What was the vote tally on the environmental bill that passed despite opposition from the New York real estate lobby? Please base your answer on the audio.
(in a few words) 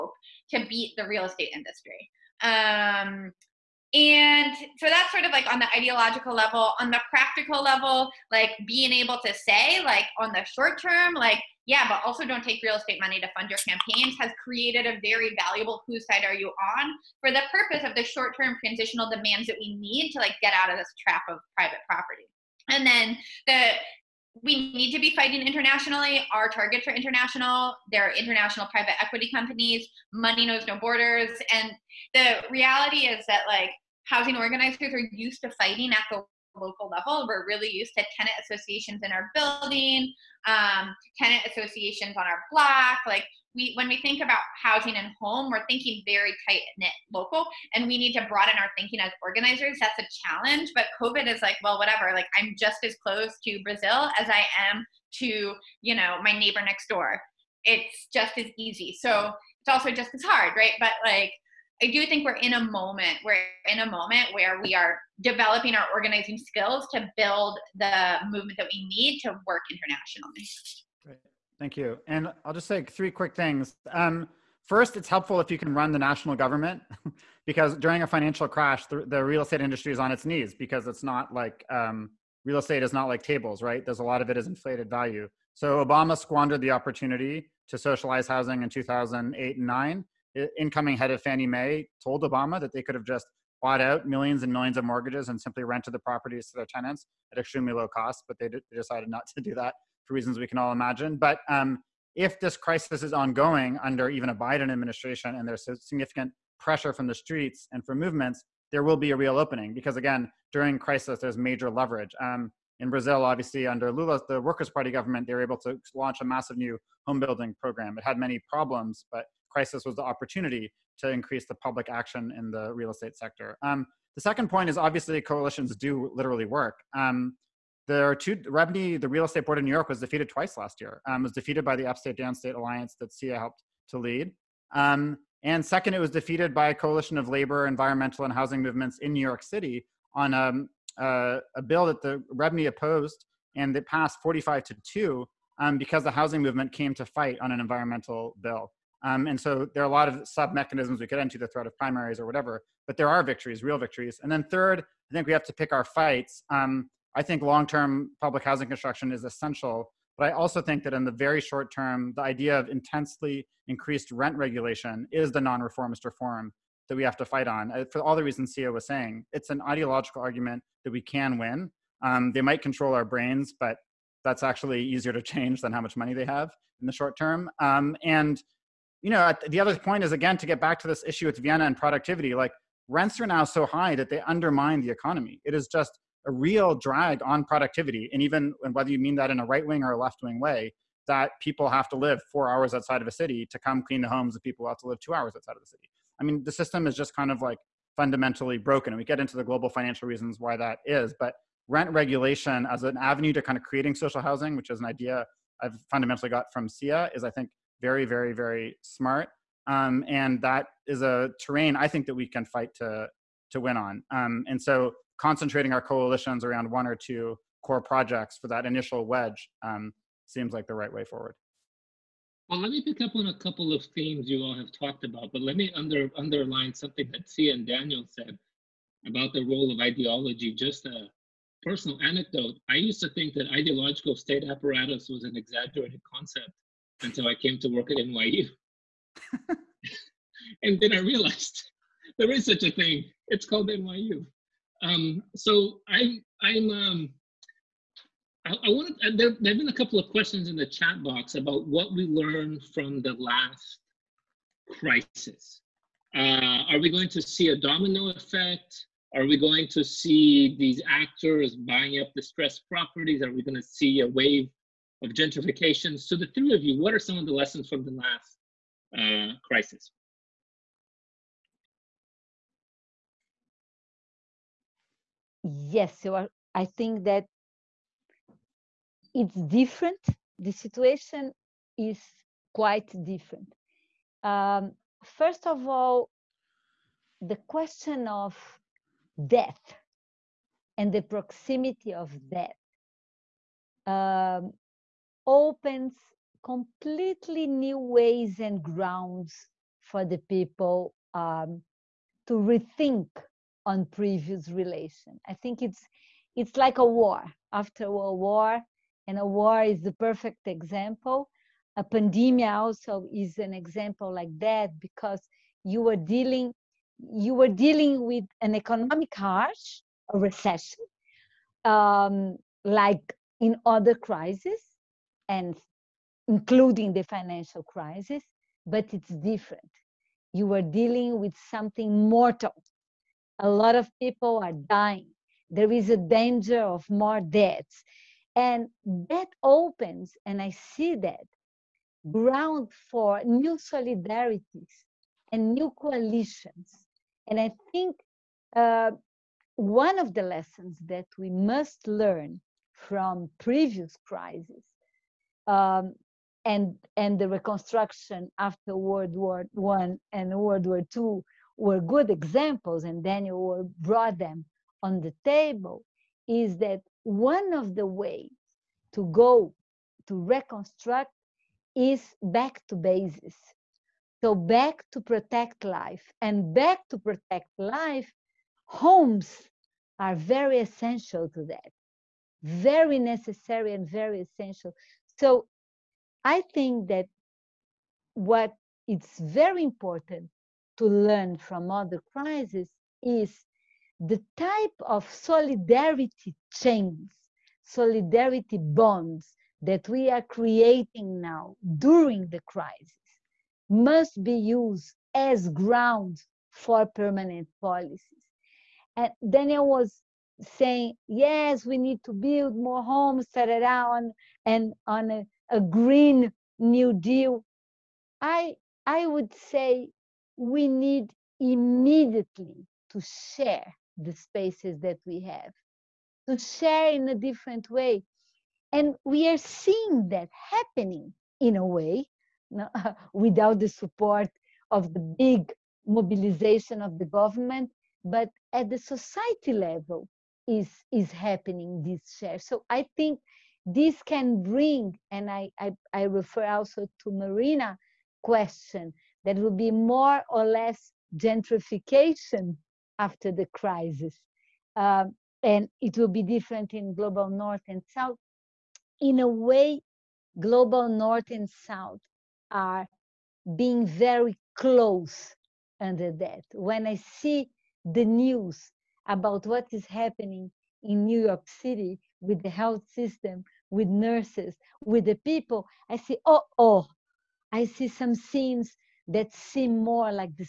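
45 to 2.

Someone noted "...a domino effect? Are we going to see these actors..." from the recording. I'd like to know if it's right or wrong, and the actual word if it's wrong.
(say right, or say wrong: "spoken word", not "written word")
right.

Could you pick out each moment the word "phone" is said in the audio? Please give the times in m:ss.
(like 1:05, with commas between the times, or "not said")
not said.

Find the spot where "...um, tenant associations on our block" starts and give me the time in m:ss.
0:40.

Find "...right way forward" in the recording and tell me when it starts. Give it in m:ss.
3:40.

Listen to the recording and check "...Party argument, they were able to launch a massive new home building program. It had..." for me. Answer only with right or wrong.
wrong.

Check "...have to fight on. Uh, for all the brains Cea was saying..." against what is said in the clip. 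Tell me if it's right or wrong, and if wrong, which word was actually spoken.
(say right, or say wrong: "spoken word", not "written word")
wrong: "reasons", not "brains".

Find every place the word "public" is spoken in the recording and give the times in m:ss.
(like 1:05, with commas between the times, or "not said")
2:01, 2:38.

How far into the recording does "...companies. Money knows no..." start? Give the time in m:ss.
0:29.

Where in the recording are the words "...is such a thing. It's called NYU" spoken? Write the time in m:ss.
4:02.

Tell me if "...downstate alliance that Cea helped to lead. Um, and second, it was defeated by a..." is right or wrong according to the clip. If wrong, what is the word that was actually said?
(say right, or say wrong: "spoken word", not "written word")
right.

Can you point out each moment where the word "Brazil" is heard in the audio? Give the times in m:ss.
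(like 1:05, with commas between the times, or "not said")
0:53, 1:52.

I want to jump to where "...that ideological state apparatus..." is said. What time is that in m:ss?
3:53.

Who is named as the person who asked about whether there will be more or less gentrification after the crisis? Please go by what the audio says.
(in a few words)
Marina.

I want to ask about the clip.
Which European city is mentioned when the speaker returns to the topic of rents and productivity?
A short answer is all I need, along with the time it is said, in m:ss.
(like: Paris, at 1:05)
Vienna, at 3:01.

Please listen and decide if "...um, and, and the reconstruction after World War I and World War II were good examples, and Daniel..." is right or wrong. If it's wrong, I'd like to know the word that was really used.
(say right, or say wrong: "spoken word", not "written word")
right.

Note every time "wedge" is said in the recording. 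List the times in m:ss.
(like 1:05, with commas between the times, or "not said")
3:39.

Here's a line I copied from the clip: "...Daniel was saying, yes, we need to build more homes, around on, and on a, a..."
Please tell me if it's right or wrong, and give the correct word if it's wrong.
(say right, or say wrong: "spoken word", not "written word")
right.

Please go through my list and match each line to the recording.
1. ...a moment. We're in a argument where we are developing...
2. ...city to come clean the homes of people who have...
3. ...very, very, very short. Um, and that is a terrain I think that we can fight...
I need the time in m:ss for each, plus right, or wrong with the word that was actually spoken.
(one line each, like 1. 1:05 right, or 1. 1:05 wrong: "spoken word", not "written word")
1. 1:02 wrong: "moment", not "argument"
2. 3:13 right
3. 3:27 wrong: "smart", not "short".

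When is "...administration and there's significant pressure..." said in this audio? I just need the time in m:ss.
1:44.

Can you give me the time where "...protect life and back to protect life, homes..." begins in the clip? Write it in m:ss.
6:15.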